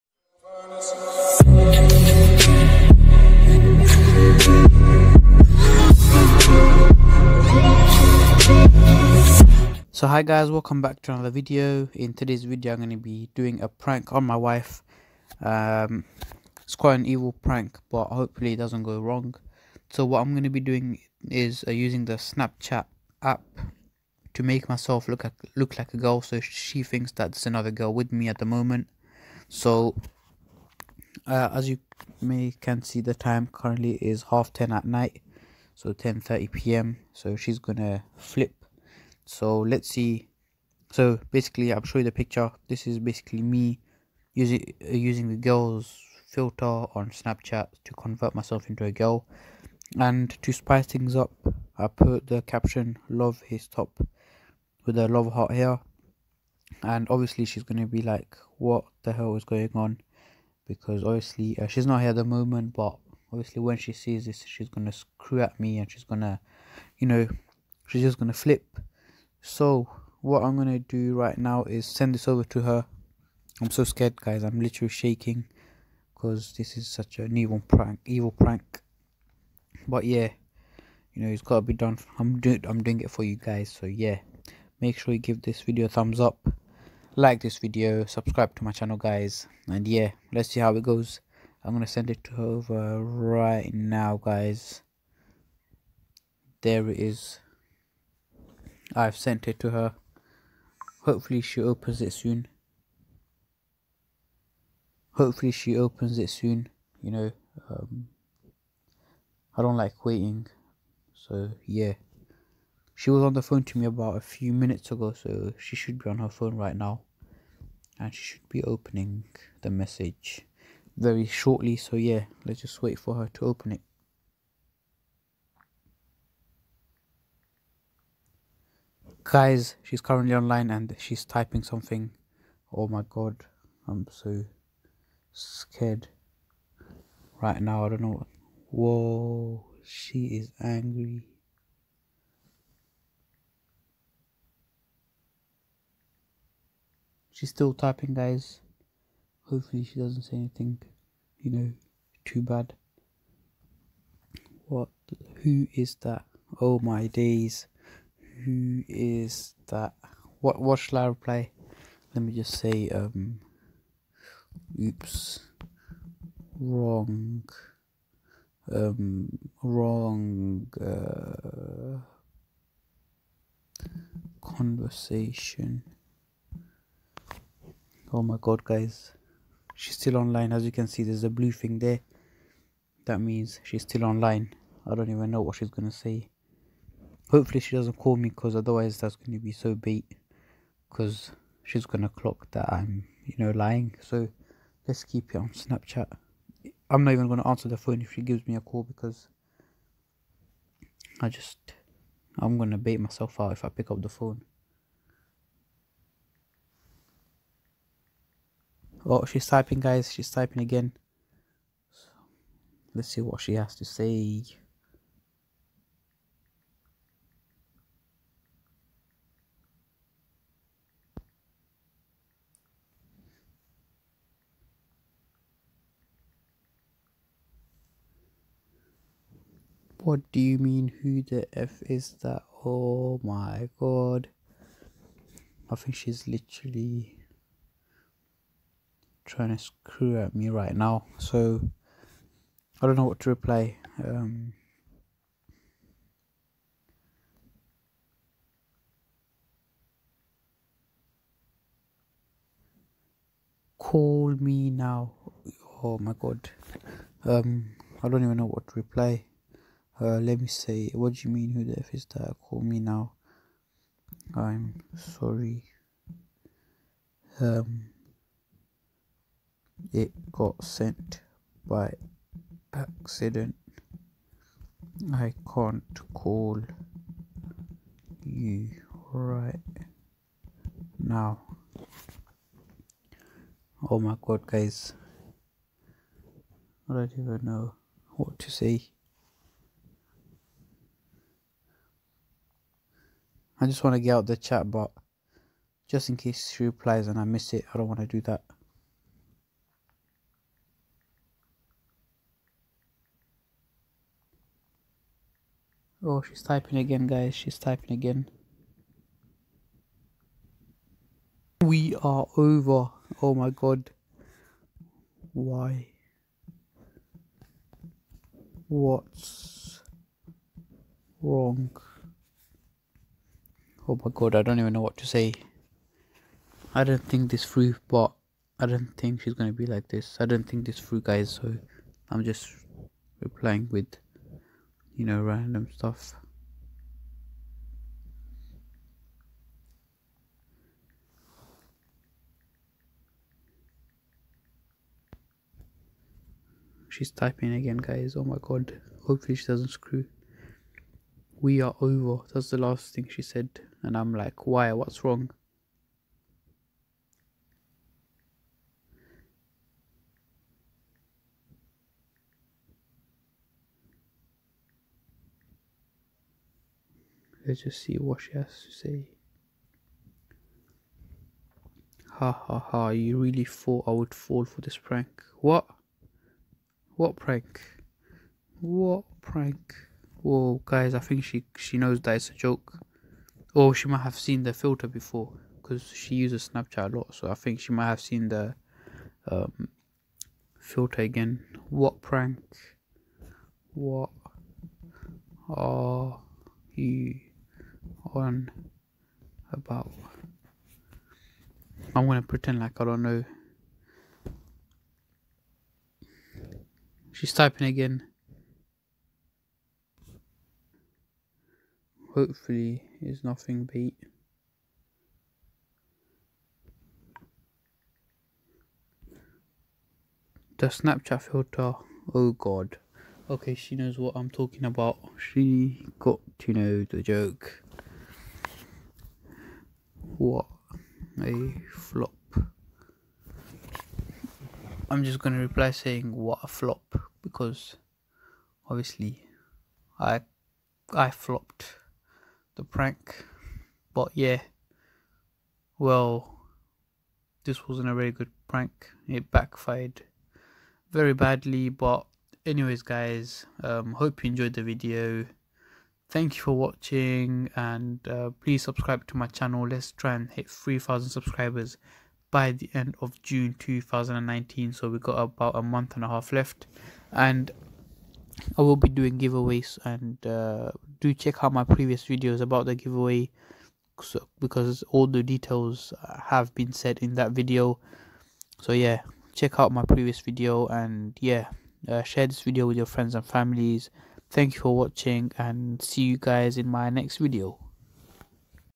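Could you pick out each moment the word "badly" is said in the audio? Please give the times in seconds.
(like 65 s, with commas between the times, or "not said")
451 s.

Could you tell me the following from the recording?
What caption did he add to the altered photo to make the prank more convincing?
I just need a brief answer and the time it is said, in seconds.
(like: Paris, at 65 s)
love his top, at 53 s.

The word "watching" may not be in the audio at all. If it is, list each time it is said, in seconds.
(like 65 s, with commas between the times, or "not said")
456 s, 484 s.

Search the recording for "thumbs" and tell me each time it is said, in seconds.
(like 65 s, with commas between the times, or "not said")
85 s.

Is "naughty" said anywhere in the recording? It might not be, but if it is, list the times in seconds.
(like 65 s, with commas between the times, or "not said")
not said.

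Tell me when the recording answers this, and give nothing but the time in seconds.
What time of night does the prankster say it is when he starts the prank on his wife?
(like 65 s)
35 s.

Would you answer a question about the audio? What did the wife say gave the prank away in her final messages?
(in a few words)
The Snapchat filter.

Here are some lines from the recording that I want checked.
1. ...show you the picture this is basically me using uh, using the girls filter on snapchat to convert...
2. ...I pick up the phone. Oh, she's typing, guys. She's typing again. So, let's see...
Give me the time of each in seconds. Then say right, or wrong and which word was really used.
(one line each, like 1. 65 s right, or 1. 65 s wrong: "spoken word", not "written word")
1. 41 s right
2. 203 s right.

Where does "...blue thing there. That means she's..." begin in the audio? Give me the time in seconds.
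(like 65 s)
181 s.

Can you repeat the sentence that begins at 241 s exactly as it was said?
So I don't know what to reply.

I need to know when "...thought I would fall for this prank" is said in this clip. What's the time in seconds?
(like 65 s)
373 s.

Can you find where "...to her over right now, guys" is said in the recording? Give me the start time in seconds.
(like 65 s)
92 s.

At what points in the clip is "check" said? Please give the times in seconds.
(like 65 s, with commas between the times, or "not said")
471 s, 479 s.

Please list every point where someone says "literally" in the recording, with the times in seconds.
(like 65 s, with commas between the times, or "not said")
74 s, 236 s.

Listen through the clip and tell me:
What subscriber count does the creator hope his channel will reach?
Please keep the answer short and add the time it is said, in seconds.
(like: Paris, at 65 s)
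3,000, at 460 s.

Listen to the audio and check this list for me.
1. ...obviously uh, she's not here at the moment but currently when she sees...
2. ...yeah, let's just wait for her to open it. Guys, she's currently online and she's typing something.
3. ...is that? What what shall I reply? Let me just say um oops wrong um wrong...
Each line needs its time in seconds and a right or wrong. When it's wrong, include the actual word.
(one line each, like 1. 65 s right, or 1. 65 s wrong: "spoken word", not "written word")
1. 61 s wrong: "obviously", not "currently"
2. 121 s right
3. 158 s right.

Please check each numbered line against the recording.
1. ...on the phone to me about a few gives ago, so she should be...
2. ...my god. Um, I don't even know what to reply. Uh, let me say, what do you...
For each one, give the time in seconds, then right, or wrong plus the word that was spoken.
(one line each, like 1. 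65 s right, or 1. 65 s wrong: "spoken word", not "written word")
1. 113 s wrong: "minutes", not "gives"
2. 255 s right.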